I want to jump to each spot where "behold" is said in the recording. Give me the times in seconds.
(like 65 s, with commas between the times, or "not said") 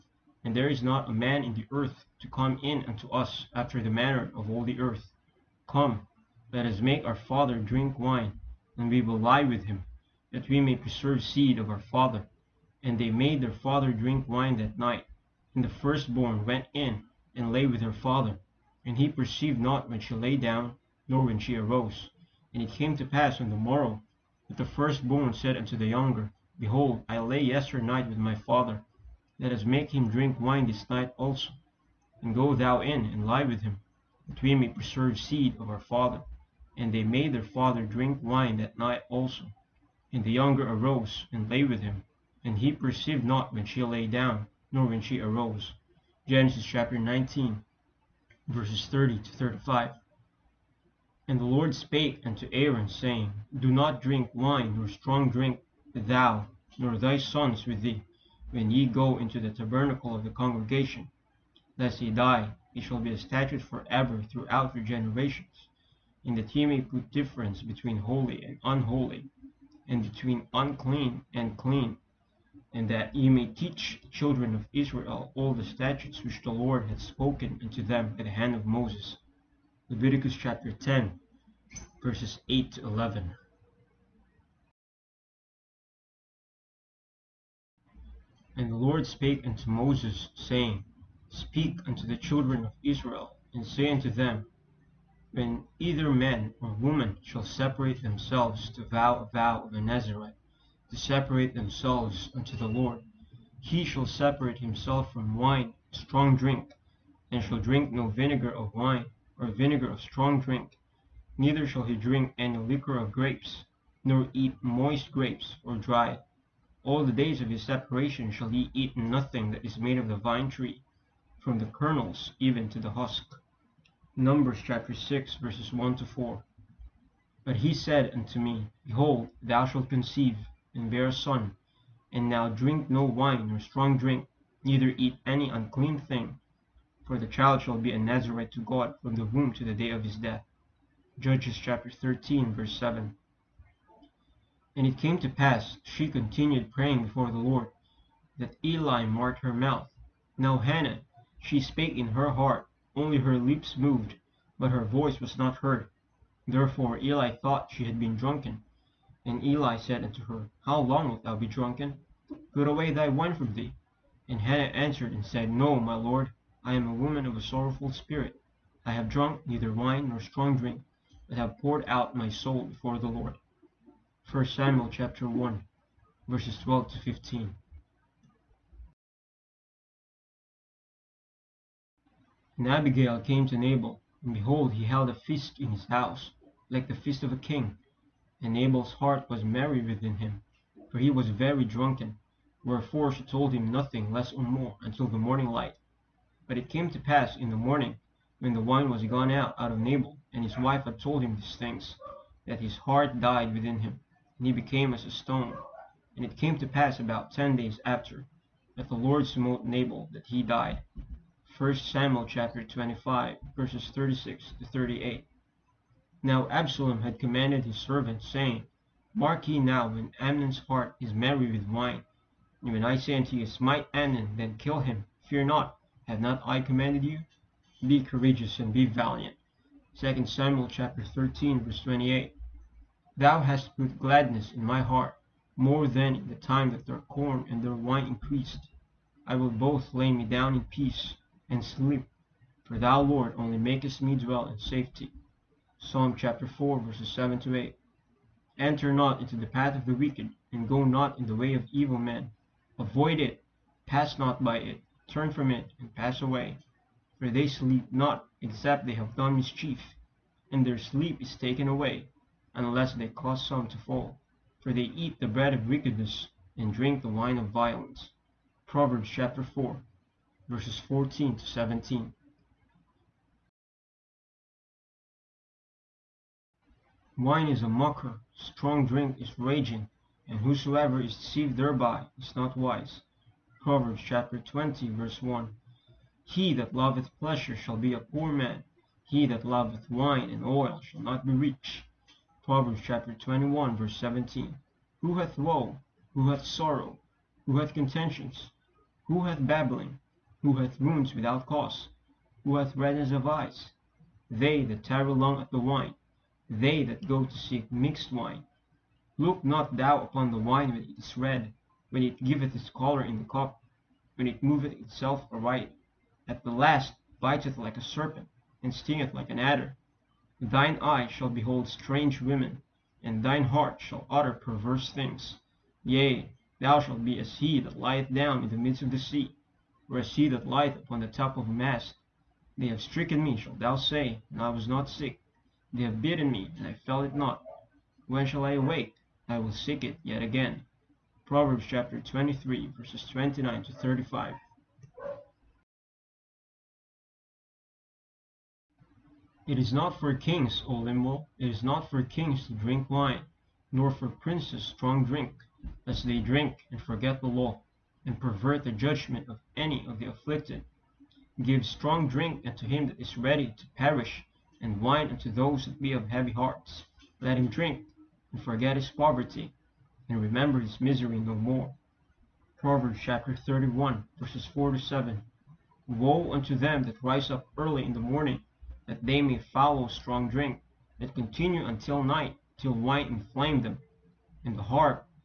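26 s, 128 s, 184 s, 321 s.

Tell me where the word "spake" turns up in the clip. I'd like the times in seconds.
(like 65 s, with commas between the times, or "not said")
51 s, 89 s, 151 s.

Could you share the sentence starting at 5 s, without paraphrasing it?
Come, let us make our father drink wine, and we will lie with him, that we may preserve seed of our father.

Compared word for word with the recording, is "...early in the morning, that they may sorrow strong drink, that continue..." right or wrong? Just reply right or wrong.
wrong.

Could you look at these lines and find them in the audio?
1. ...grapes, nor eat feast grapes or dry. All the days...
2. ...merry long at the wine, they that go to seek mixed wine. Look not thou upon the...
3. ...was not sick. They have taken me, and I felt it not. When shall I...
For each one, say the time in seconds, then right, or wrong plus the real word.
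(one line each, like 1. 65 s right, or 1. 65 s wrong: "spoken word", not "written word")
1. 113 s wrong: "moist", not "feast"
2. 304 s wrong: "tarry", not "merry"
3. 334 s wrong: "bitten", not "taken".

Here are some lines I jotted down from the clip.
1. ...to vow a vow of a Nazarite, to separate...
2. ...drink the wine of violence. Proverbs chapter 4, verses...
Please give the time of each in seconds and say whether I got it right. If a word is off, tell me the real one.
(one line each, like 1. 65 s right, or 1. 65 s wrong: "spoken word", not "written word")
1. 98 s right
2. 266 s right.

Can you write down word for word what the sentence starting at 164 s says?
And Hannah answered and said, No, my lord, I am a woman of a sorrowful spirit.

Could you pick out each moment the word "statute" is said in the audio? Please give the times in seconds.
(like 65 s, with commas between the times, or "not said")
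63 s, 75 s.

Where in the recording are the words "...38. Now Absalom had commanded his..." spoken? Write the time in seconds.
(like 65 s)
214 s.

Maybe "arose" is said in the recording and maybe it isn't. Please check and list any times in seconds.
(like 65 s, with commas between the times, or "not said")
21 s, 40 s, 45 s.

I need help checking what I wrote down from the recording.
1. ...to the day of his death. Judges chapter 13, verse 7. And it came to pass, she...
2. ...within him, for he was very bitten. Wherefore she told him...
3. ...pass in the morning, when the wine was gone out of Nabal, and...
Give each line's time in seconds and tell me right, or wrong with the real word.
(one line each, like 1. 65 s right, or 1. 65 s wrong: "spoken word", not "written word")
1. 139 s right
2. 189 s wrong: "drunken", not "bitten"
3. 197 s right.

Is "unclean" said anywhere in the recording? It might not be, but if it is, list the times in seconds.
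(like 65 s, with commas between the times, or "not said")
70 s, 135 s.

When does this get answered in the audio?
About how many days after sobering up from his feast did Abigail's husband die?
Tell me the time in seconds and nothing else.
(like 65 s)
207 s.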